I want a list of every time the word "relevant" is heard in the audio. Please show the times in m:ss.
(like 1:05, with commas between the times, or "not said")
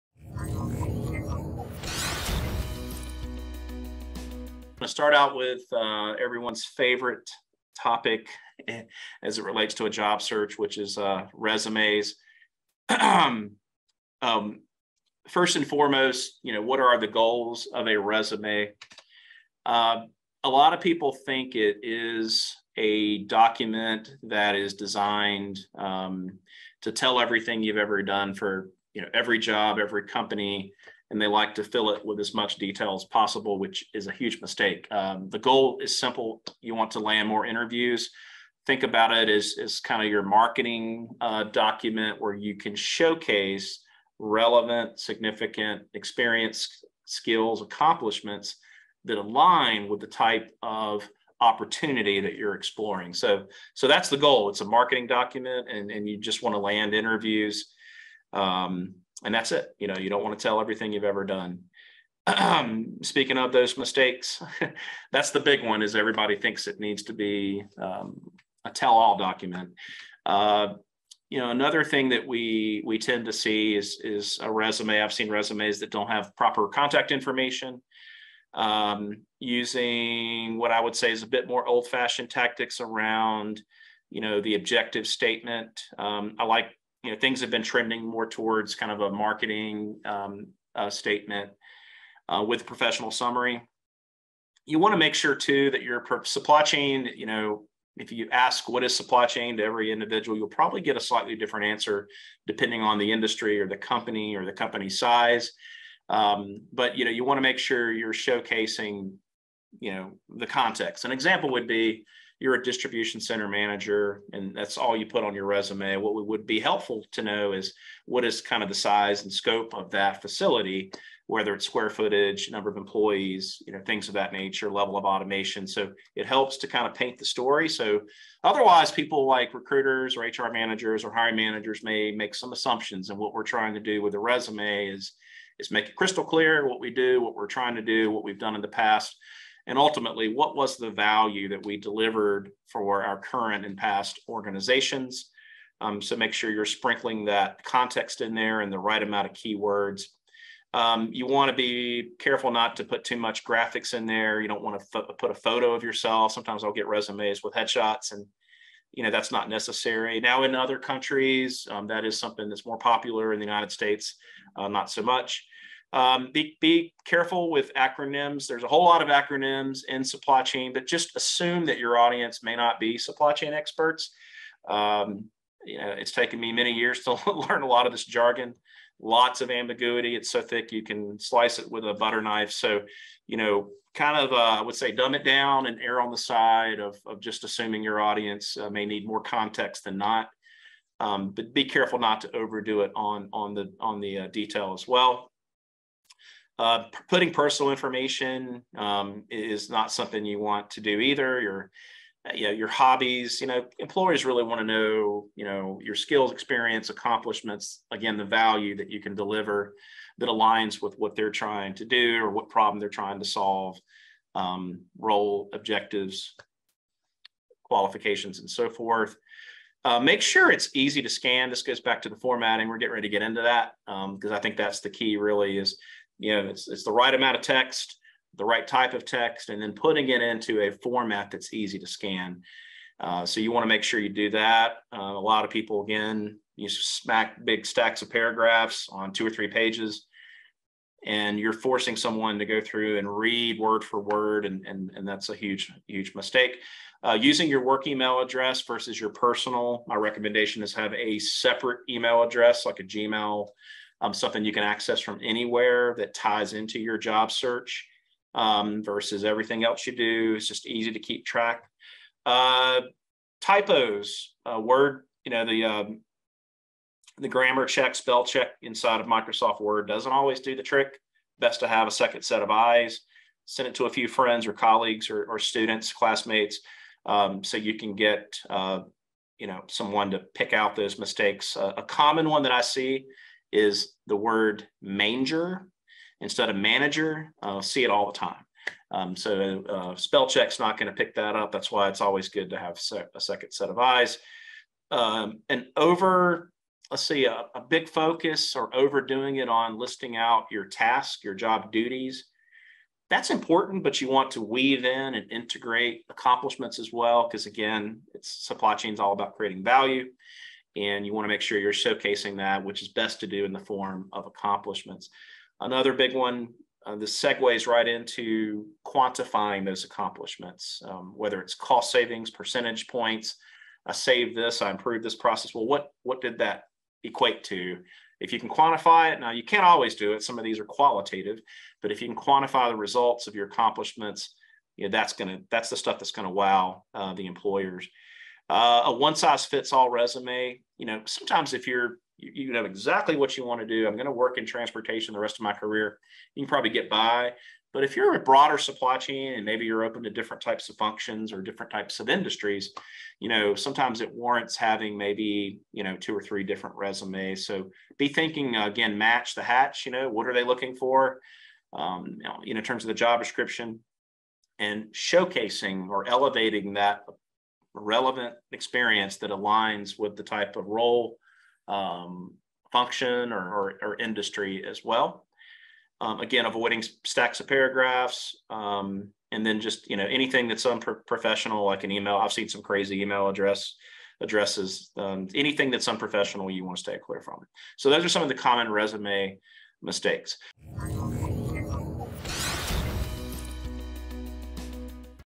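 0:44, 6:07.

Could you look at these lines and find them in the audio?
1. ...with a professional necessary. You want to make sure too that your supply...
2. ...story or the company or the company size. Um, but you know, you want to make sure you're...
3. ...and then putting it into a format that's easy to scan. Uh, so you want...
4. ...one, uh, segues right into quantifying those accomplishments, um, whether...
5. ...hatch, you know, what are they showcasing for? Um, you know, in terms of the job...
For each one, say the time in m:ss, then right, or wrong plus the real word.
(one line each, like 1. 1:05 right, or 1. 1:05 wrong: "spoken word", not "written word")
1. 1:32 wrong: "summary", not "necessary"
2. 1:43 wrong: "industry", not "story"
3. 3:49 right
4. 5:16 right
5. 5:59 wrong: "looking", not "showcasing".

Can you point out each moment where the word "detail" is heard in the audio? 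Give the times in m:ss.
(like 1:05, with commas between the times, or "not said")
0:32, 3:14.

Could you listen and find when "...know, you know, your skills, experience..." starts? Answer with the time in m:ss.
3:24.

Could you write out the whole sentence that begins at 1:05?
Is everybody thinks it needs to be um, a tell-all document.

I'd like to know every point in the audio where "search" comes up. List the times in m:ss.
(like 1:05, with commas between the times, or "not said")
0:10, 4:17.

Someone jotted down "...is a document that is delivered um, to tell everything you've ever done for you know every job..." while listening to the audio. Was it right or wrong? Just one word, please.
wrong.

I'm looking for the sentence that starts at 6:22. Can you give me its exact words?
I've seen some crazy email address addresses.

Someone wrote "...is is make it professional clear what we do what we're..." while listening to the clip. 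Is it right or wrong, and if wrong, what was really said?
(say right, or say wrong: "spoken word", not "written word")
wrong: "crystal", not "professional".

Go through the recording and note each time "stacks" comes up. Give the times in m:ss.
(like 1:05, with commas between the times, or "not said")
3:57, 6:17.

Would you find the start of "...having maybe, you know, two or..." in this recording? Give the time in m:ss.
5:54.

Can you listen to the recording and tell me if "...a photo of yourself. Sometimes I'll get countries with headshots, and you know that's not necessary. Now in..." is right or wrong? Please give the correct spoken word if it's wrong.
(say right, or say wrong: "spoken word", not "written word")
wrong: "resumes", not "countries".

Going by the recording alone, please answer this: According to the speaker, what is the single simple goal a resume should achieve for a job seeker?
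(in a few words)
Land more interviews.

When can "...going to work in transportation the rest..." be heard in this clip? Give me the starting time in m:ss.
5:43.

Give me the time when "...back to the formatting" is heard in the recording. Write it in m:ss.
3:41.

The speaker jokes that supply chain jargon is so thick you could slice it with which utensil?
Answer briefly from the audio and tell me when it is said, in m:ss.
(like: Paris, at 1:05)
Butter knife, at 3:01.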